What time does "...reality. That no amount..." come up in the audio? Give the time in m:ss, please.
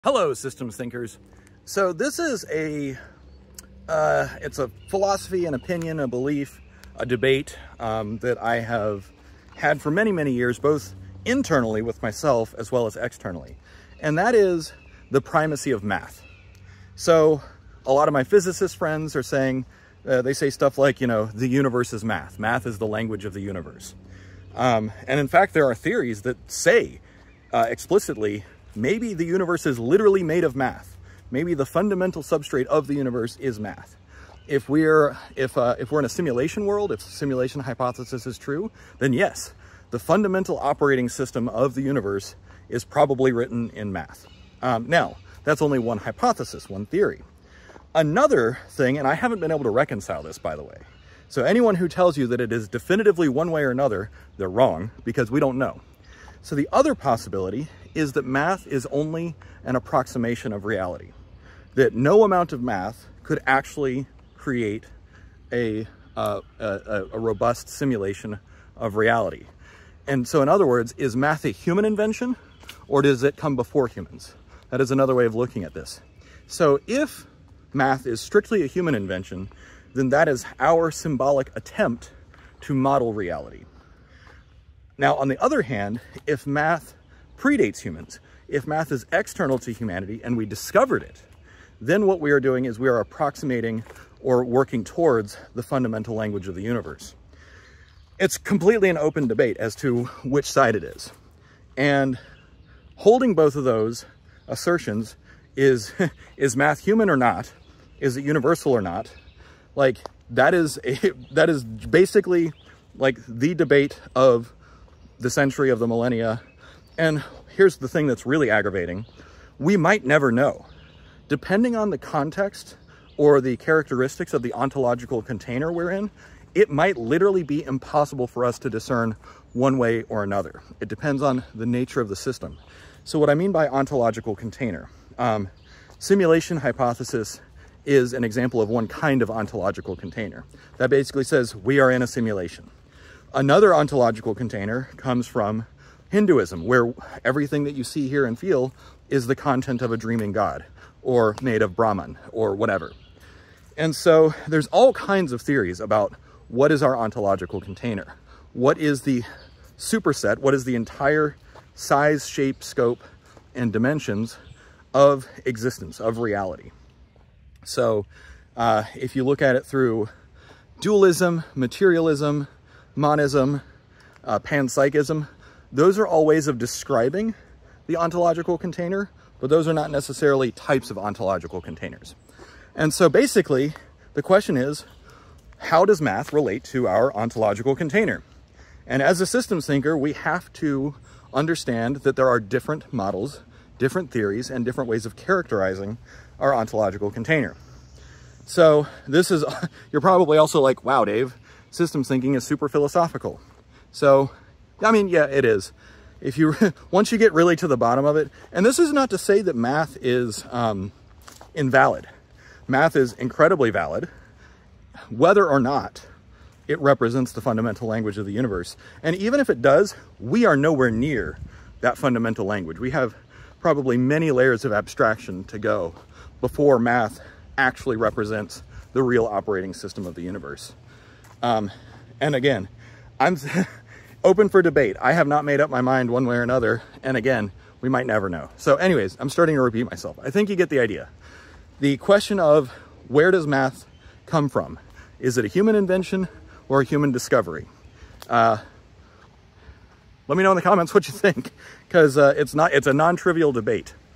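1:00.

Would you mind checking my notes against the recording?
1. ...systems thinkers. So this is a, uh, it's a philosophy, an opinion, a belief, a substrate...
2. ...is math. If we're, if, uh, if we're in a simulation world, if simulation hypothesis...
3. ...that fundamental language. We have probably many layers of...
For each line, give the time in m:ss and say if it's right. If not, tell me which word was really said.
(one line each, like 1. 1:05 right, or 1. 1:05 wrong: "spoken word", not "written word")
1. 0:00 wrong: "debate", not "substrate"
2. 0:33 right
3. 3:41 right.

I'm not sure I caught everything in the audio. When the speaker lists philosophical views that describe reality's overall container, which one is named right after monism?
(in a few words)
panpsychism.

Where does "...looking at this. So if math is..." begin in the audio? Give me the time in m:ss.
1:15.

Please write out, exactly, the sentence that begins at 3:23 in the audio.
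So I mean, yeah, it is.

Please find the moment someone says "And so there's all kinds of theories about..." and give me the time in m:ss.
2:33.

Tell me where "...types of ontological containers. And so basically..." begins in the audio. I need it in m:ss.
3:00.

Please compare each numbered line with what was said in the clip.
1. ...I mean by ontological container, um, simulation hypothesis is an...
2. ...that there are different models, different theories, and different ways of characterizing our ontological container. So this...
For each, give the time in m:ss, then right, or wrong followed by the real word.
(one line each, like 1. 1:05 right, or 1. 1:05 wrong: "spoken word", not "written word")
1. 2:13 right
2. 3:11 right.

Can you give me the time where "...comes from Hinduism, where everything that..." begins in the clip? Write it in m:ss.
2:24.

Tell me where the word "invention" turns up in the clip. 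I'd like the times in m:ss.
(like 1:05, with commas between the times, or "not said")
1:11, 1:18, 4:05.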